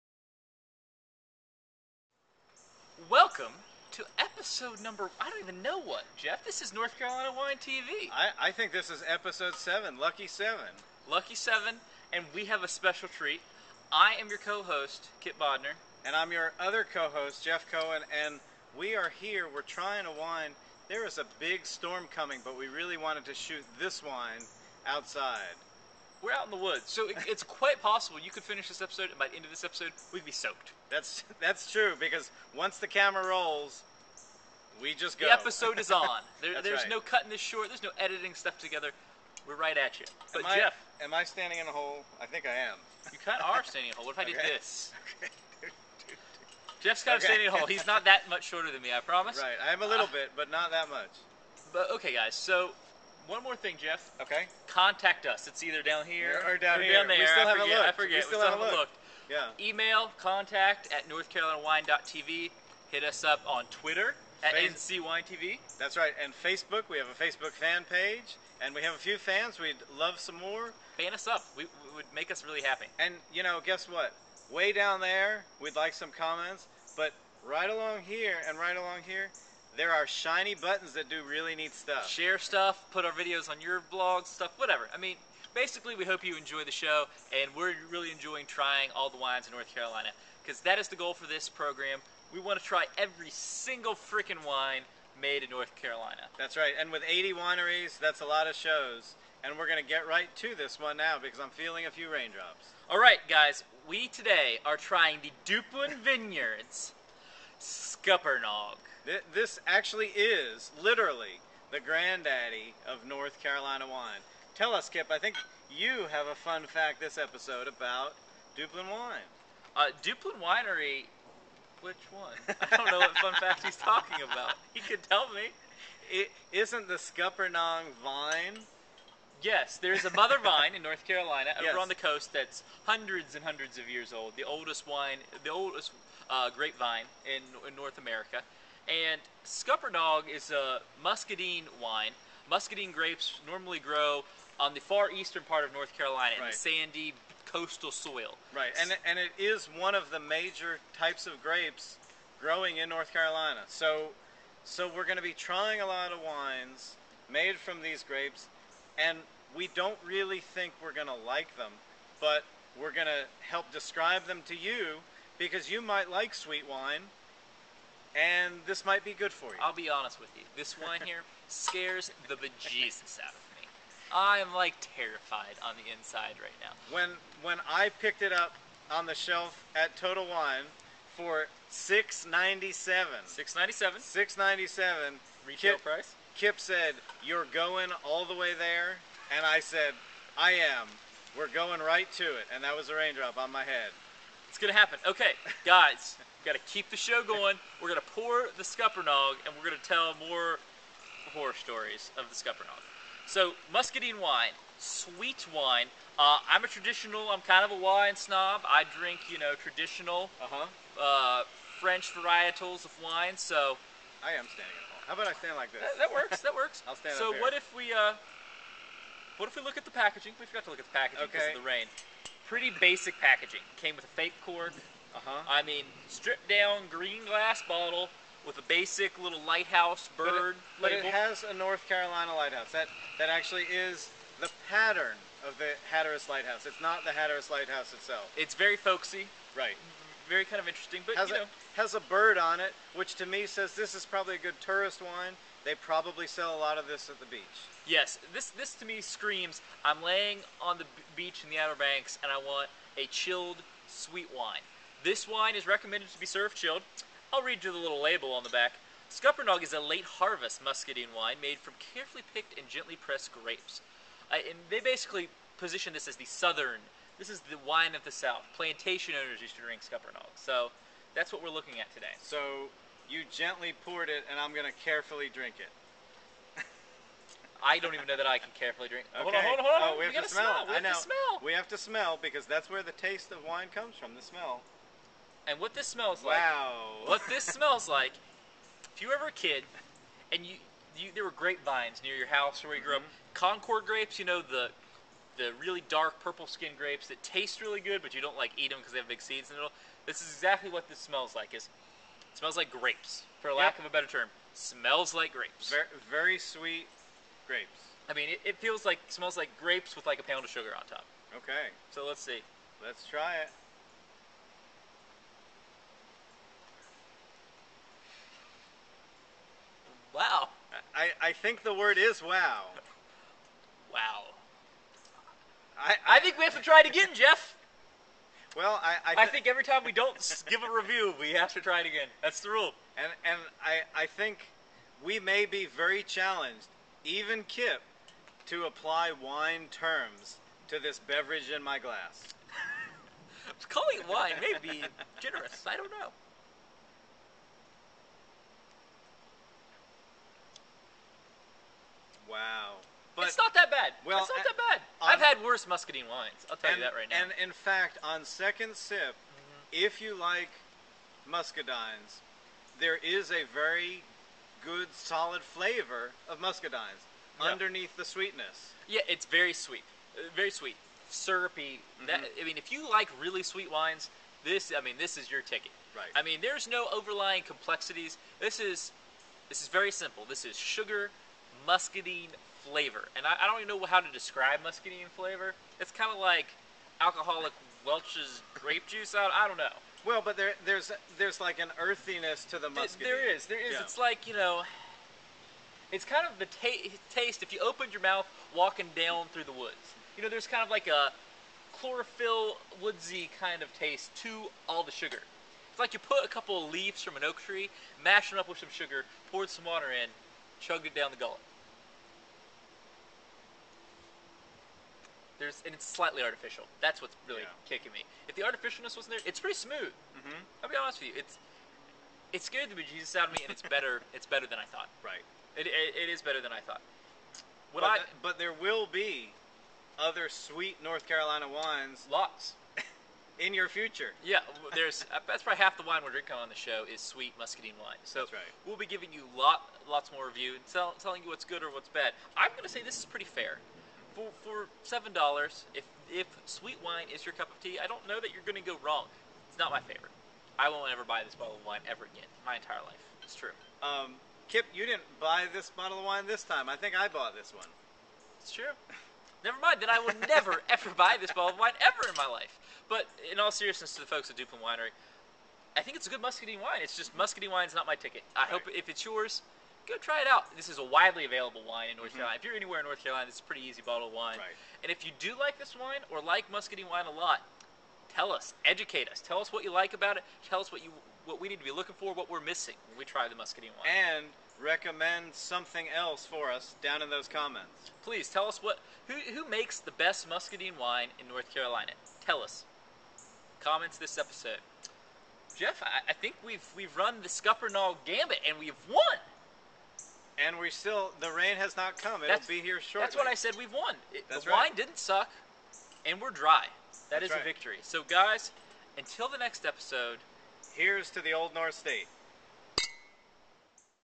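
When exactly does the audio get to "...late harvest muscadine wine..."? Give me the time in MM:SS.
04:19.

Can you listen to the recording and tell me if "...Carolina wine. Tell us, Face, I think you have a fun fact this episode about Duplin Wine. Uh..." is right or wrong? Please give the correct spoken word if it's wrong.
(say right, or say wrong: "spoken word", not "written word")
wrong: "Kip", not "Face".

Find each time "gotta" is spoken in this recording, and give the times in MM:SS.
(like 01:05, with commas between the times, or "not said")
03:16.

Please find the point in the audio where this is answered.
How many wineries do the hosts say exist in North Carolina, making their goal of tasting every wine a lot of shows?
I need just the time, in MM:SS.
01:37.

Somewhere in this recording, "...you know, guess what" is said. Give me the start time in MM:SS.
01:13.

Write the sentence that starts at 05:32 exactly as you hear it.
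And and I I think we may be very challenged, even Kip, to apply wine terms to this beverage in my glass.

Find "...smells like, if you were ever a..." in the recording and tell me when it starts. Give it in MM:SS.
04:47.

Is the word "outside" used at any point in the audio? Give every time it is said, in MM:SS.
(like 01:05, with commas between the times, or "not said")
00:24.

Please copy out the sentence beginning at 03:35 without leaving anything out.
How about I stand like this?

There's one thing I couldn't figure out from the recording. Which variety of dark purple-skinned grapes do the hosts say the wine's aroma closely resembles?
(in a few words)
Concord.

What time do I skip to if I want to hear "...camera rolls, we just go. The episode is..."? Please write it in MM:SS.
00:32.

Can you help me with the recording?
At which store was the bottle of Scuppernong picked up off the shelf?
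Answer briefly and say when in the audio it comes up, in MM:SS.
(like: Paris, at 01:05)
Total Wine, at 02:59.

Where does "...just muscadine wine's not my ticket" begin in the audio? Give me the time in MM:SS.
07:46.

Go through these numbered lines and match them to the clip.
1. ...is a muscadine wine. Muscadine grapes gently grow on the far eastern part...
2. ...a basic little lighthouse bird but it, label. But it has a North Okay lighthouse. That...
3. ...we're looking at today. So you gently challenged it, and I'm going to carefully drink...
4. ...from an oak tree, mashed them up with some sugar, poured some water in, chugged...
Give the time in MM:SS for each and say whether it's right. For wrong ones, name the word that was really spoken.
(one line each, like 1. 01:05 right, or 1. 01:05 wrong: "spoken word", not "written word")
1. 02:20 wrong: "normally", not "gently"
2. 03:48 wrong: "Carolina", not "Okay"
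3. 04:31 wrong: "poured", not "challenged"
4. 06:47 right.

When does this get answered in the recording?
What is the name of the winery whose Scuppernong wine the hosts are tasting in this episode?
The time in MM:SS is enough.
01:45.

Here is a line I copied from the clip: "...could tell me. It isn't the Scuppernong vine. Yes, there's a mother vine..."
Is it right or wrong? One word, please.
right.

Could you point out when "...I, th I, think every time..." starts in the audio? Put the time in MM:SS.
05:29.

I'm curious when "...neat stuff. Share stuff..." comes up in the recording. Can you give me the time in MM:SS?
01:21.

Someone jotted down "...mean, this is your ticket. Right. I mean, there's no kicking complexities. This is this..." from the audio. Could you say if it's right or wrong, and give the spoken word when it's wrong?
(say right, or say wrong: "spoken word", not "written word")
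wrong: "overlying", not "kicking".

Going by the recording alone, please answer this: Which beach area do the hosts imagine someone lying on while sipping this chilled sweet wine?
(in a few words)
Outer Banks.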